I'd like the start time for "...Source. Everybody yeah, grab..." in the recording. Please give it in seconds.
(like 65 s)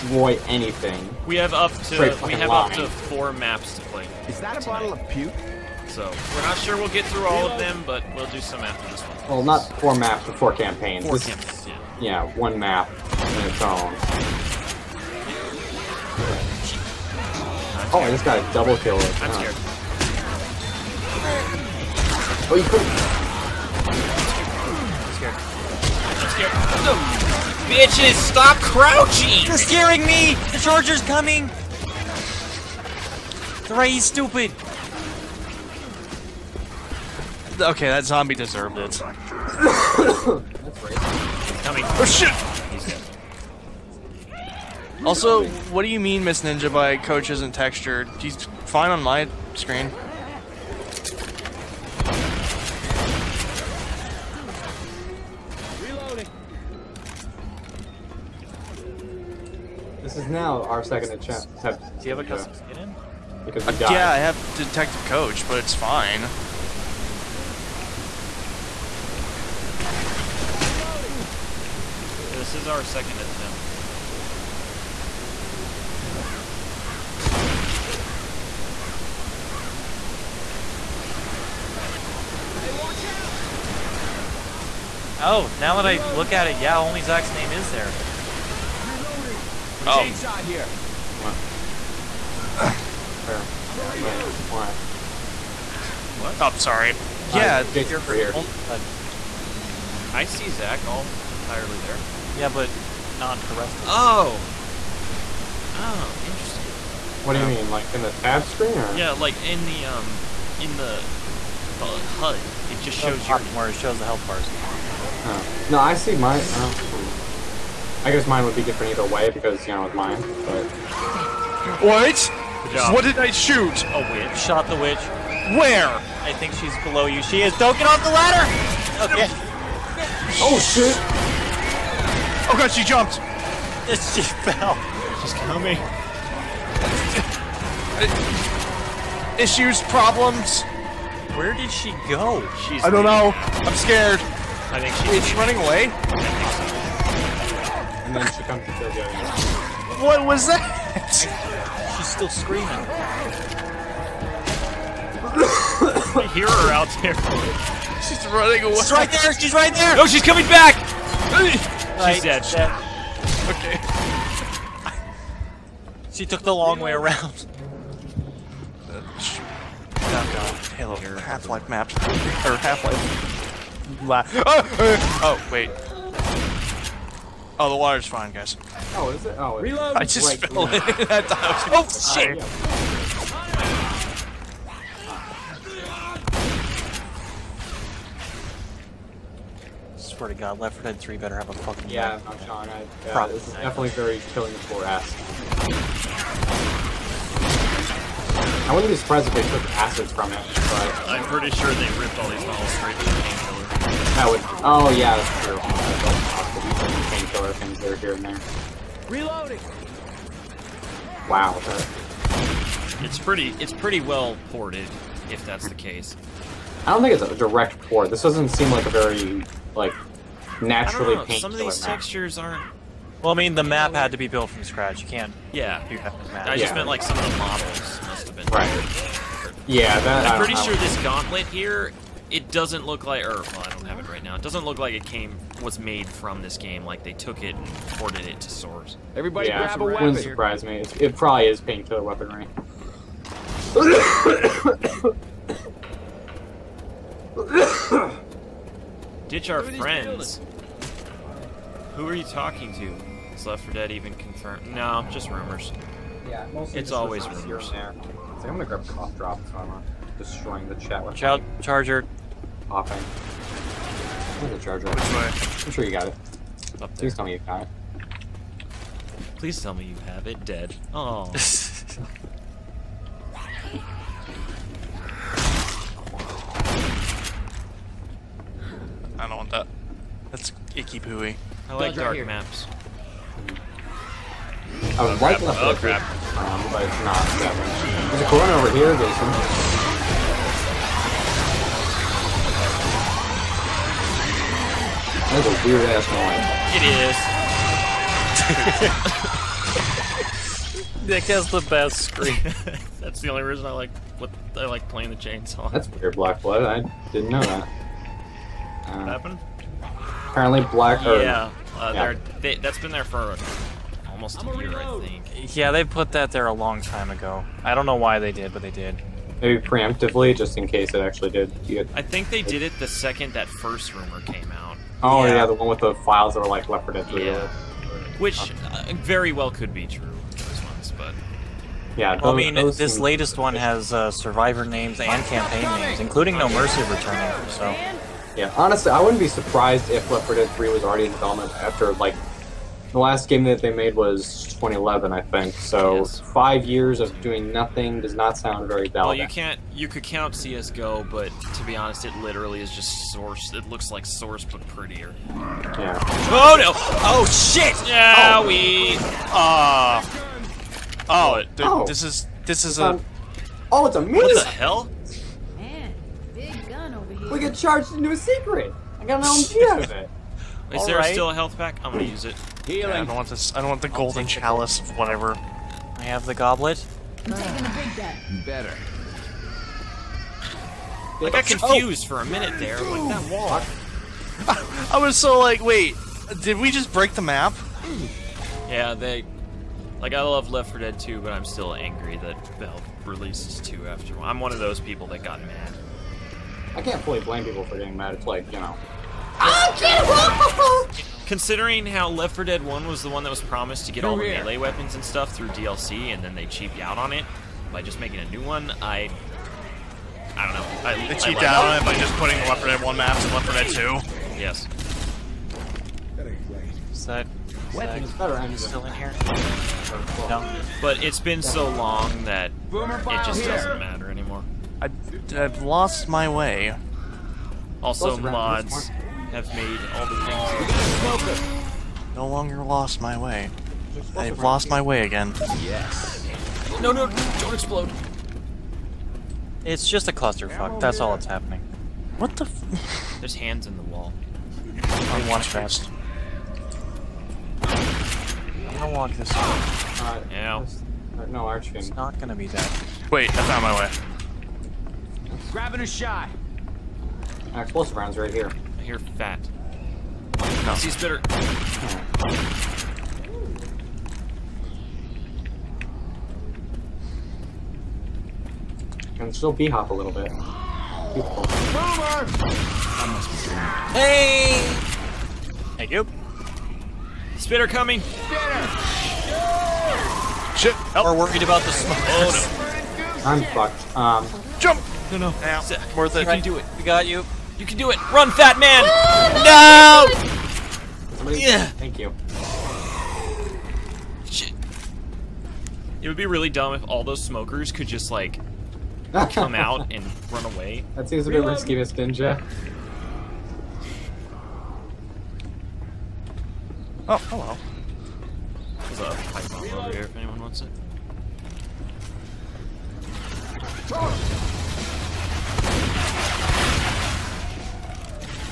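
238 s.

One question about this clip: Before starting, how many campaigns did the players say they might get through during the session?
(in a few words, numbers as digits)
4.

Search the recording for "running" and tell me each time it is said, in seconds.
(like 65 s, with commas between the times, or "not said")
145 s, 158 s.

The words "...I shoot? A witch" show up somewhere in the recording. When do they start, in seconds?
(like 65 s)
123 s.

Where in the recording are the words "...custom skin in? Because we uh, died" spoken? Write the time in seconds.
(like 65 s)
62 s.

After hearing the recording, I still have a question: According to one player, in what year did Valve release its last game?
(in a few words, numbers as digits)
2011.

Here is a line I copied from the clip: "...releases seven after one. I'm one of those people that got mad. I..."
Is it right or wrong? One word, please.
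wrong.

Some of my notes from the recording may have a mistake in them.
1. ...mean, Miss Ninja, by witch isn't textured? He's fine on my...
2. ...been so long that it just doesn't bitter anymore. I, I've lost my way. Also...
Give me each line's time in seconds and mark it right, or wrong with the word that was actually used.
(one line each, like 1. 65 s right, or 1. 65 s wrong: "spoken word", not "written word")
1. 46 s wrong: "coach", not "witch"
2. 421 s wrong: "matter", not "bitter".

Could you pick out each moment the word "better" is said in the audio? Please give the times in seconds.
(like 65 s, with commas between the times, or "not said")
191 s, 378 s, 418 s.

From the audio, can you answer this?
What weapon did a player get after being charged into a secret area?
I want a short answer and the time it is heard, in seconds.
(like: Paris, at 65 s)
LMG, at 369 s.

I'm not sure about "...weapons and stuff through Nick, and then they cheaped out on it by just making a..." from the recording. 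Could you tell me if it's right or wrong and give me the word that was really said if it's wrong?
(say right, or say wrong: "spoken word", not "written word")
wrong: "DLC", not "Nick".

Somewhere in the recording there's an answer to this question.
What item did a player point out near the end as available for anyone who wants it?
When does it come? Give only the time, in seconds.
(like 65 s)
509 s.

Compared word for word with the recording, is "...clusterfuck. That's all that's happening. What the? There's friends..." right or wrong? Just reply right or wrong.
wrong.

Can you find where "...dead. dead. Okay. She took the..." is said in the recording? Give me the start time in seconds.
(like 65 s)
162 s.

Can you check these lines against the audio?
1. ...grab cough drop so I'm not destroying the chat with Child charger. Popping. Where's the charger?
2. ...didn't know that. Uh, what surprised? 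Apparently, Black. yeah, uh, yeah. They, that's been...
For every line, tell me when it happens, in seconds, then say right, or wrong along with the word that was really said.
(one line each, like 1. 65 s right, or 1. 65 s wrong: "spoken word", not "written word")
1. 258 s right
2. 307 s wrong: "happened", not "surprised".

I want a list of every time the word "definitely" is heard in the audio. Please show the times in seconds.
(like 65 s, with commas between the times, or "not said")
193 s.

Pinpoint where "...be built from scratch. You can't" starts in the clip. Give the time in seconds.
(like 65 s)
224 s.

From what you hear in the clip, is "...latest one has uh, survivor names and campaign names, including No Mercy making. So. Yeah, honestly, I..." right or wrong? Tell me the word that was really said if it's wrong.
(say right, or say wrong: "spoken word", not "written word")
wrong: "returning", not "making".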